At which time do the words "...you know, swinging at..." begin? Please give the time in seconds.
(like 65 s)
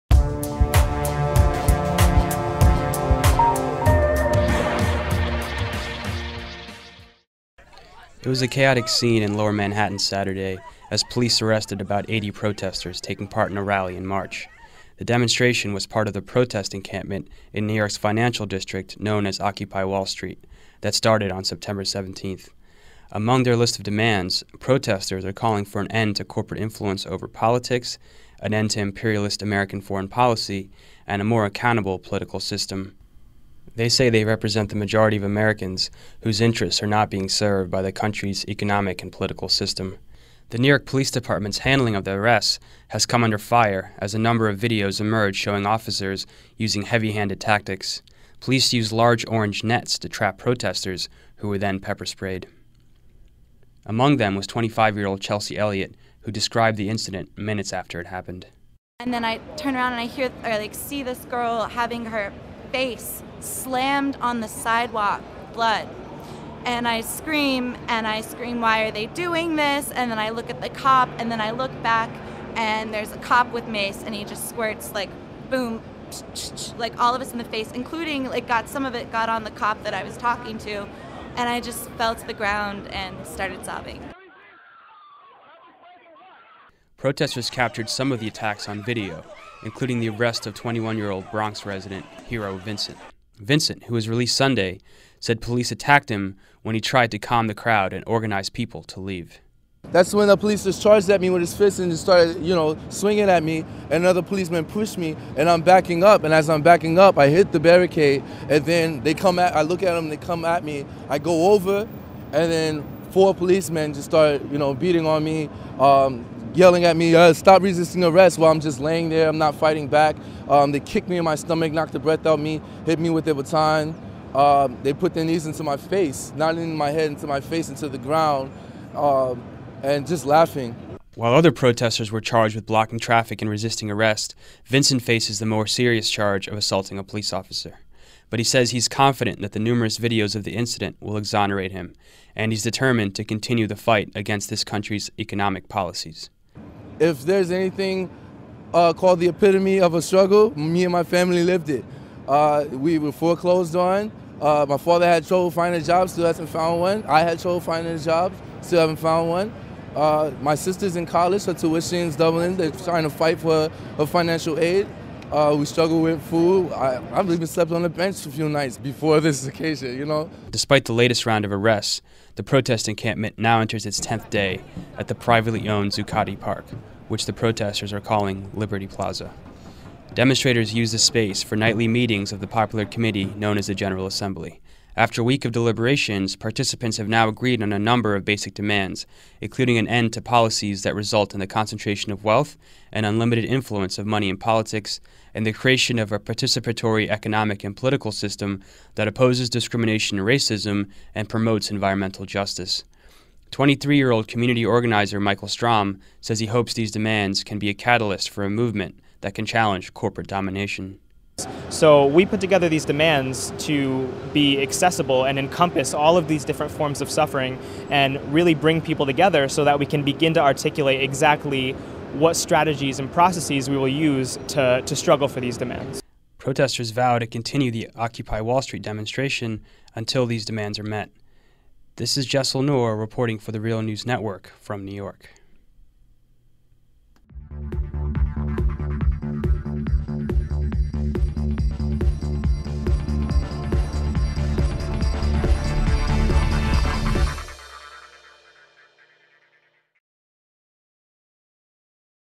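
102 s.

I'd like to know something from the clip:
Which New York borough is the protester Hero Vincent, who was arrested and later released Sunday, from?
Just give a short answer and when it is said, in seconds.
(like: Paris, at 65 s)
Bronx, at 91 s.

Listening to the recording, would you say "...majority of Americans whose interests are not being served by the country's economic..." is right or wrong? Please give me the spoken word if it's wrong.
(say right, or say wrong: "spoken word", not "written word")
right.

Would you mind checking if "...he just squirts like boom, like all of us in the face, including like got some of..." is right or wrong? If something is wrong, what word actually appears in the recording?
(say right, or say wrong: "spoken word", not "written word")
right.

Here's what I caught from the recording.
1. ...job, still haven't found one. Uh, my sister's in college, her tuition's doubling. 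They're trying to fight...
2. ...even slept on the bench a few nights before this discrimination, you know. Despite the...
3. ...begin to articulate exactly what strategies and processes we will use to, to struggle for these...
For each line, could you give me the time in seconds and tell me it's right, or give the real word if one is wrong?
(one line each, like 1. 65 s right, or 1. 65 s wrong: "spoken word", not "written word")
1. 157 s right
2. 167 s wrong: "occasion", not "discrimination"
3. 220 s right.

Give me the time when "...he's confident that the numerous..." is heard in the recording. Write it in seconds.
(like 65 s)
138 s.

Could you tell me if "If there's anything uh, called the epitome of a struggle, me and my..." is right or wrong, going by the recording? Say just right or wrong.
right.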